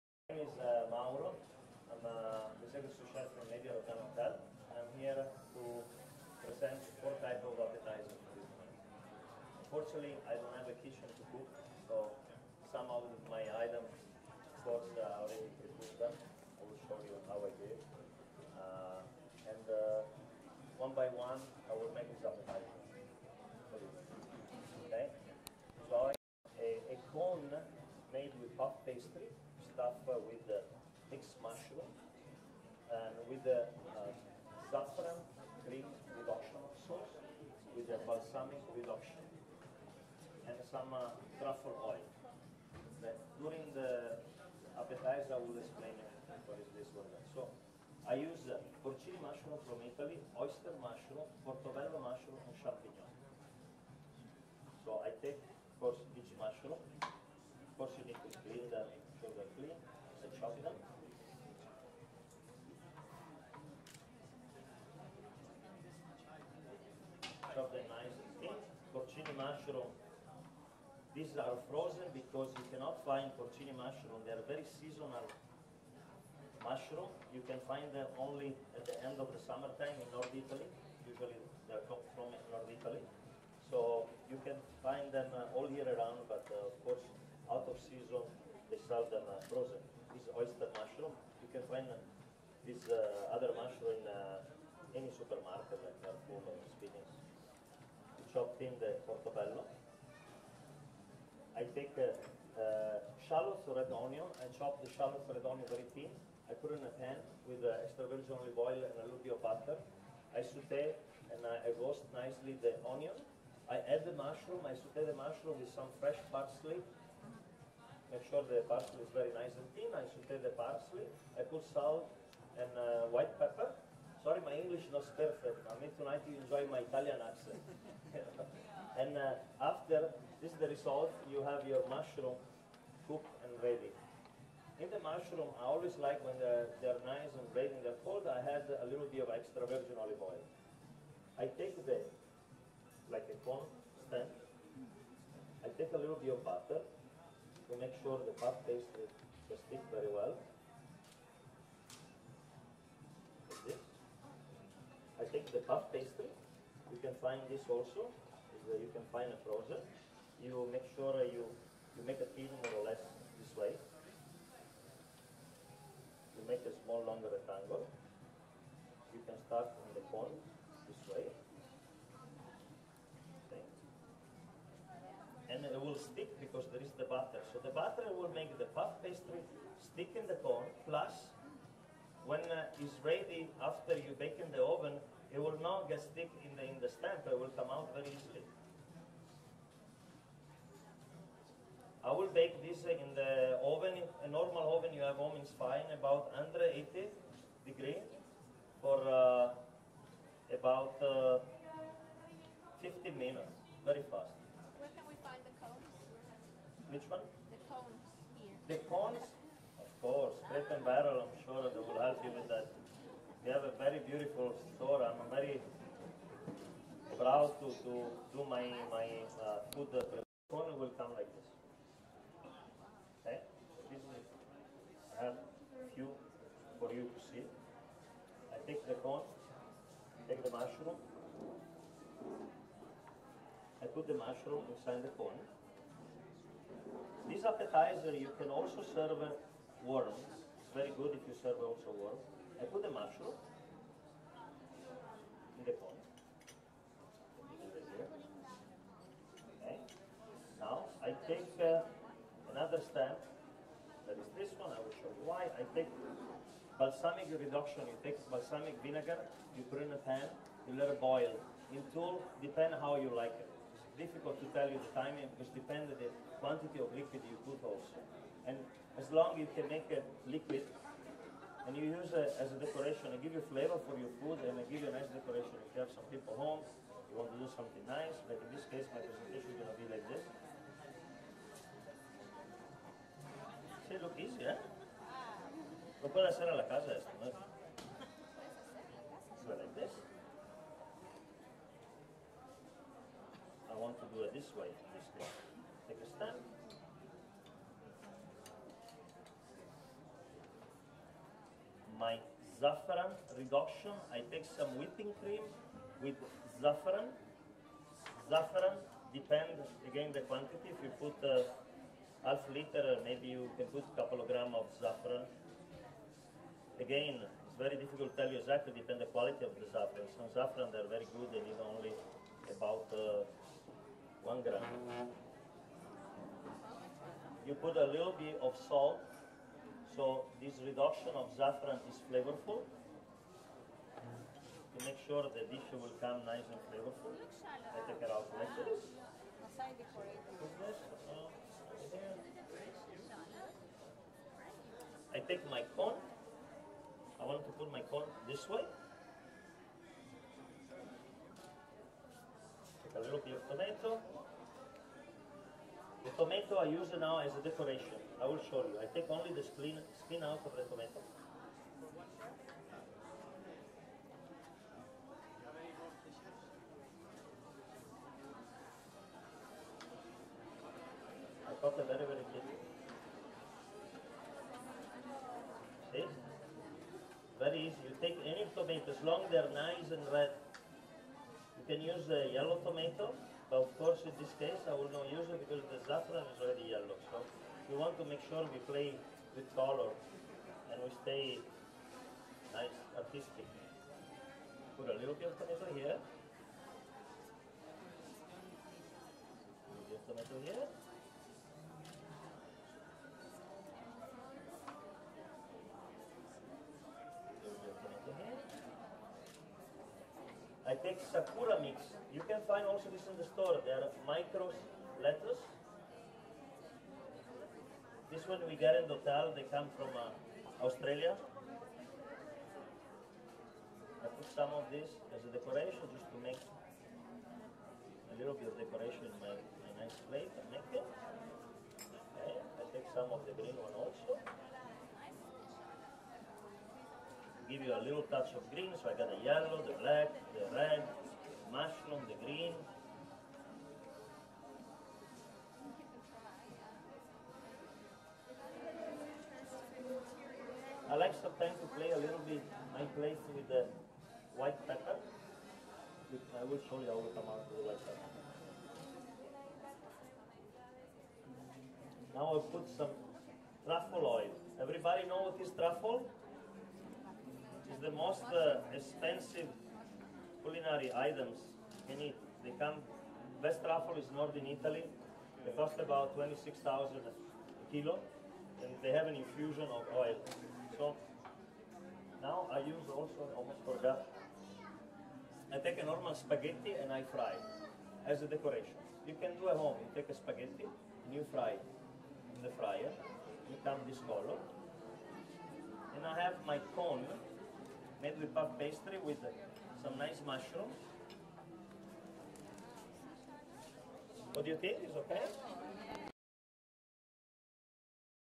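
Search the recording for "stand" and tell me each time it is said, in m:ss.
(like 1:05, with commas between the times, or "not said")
2:24, 4:56.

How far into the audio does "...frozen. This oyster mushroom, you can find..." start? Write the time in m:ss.
1:29.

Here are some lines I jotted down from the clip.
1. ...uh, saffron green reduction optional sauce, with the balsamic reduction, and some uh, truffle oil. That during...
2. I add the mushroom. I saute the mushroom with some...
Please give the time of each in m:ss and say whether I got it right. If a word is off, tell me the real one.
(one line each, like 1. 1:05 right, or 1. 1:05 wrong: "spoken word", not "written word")
1. 0:33 right
2. 1:53 right.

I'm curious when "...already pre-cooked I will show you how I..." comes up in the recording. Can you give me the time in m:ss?
0:15.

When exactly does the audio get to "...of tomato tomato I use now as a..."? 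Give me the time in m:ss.
5:53.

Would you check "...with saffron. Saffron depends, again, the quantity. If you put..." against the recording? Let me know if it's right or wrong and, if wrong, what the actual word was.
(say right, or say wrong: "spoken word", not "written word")
right.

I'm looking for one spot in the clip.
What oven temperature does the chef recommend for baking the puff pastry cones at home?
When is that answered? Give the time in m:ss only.
3:16.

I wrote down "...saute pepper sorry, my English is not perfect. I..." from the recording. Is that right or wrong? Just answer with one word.
wrong.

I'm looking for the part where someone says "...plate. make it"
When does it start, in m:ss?
7:10.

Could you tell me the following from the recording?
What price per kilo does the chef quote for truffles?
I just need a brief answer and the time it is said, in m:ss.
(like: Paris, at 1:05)
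26,000, at 7:56.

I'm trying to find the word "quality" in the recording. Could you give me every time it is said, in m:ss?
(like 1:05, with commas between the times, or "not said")
5:19.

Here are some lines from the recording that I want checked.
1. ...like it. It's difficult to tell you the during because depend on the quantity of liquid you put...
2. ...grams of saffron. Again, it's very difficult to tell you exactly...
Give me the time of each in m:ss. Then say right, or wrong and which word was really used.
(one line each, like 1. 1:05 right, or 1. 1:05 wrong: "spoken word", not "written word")
1. 4:23 wrong: "timing", not "during"
2. 5:14 right.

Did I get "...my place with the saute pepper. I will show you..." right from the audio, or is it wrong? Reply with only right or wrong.
wrong.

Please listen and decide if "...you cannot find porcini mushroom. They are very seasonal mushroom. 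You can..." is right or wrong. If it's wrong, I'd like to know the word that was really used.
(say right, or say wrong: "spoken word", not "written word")
right.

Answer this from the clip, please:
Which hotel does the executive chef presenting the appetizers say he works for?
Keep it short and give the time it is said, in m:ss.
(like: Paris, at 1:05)
Media Rotana Hotel, at 0:03.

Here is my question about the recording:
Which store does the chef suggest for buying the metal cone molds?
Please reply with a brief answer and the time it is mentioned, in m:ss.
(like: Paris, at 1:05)
Crate and Barrel, at 3:30.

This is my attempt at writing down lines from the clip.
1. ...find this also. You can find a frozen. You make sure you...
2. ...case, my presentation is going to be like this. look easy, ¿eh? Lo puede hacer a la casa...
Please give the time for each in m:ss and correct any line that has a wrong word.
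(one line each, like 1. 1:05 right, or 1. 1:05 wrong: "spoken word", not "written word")
1. 2:37 right
2. 4:38 right.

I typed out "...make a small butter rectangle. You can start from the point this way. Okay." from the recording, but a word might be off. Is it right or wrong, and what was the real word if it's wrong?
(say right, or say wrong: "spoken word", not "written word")
wrong: "longer", not "butter".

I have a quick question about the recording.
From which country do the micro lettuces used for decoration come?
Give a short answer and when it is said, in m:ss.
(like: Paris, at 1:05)
Australia, at 7:00.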